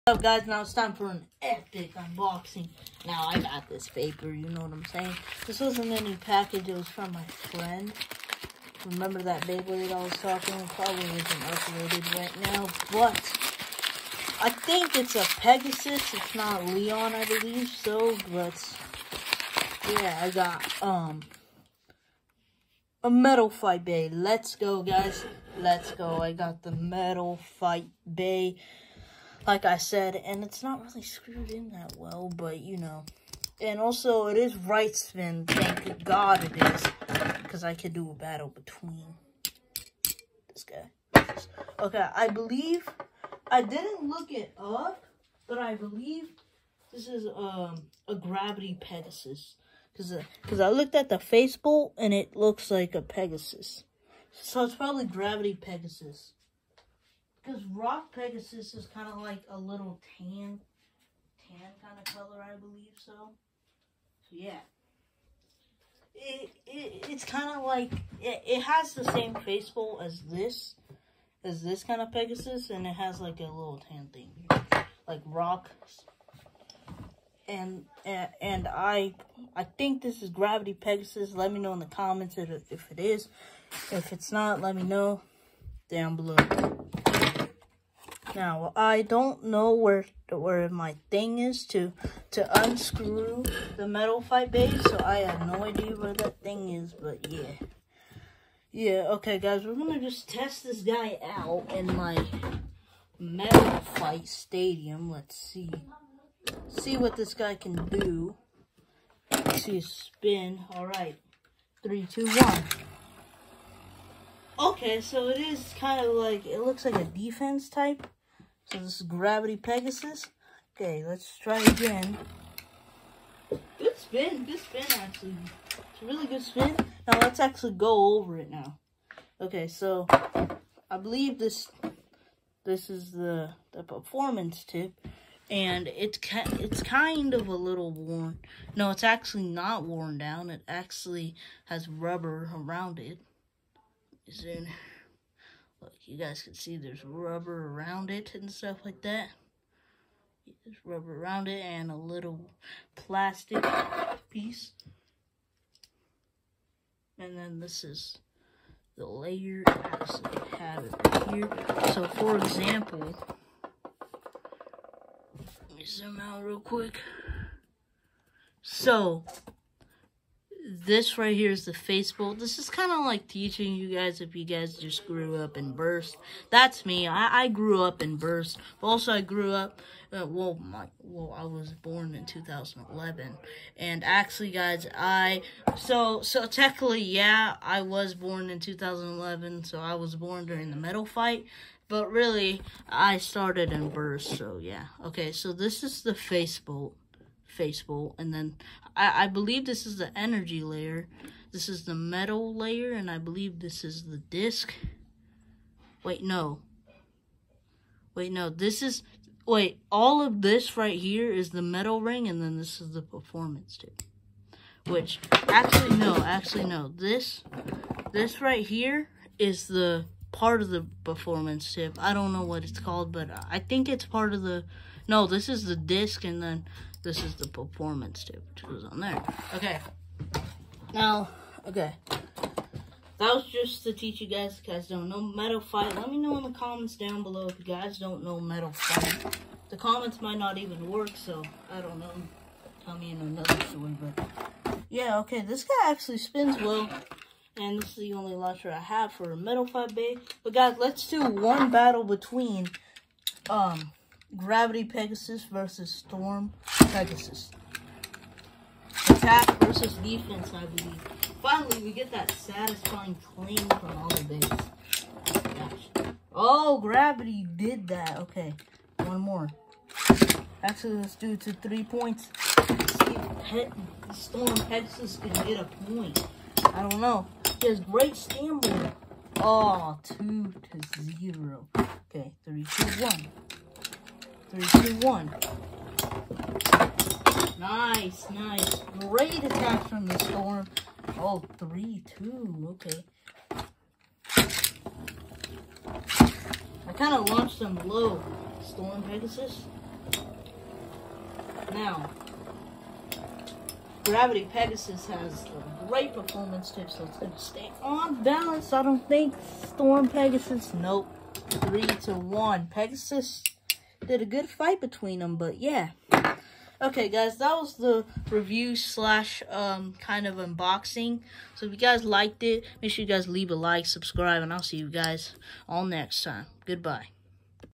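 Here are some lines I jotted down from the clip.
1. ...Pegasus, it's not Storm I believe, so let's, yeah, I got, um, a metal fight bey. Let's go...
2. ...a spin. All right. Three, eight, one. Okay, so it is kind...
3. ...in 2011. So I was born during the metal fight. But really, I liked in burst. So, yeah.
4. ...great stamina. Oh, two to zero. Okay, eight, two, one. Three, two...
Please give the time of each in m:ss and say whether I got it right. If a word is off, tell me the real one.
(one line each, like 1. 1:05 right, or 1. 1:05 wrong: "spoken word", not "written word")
1. 0:15 wrong: "Leon", not "Storm"
2. 1:49 wrong: "two", not "eight"
3. 3:08 wrong: "started", not "liked"
4. 4:37 wrong: "three", not "eight".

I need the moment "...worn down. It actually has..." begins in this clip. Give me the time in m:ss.
2:19.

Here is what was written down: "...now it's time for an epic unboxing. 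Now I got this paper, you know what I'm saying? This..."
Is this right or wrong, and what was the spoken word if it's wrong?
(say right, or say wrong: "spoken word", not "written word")
right.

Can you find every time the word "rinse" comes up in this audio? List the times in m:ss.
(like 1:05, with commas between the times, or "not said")
not said.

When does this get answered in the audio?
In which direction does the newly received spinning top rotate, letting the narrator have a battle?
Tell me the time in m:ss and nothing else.
0:34.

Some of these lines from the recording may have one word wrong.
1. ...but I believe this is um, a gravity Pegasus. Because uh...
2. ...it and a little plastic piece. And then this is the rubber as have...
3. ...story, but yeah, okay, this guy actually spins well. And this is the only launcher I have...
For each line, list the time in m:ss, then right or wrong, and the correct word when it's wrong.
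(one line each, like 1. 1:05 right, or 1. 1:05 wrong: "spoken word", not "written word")
1. 0:45 right
2. 2:31 wrong: "layer", not "rubber"
3. 4:03 right.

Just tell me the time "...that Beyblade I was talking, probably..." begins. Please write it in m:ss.
0:09.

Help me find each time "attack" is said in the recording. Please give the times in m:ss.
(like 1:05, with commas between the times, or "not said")
4:19, 4:49.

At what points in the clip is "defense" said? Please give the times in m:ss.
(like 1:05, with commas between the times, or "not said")
1:57, 4:19.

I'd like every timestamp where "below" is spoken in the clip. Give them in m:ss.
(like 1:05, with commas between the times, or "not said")
1:26, 3:57.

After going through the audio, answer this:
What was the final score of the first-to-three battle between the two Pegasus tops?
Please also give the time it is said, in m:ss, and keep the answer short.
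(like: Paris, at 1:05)
3 to 1, at 5:11.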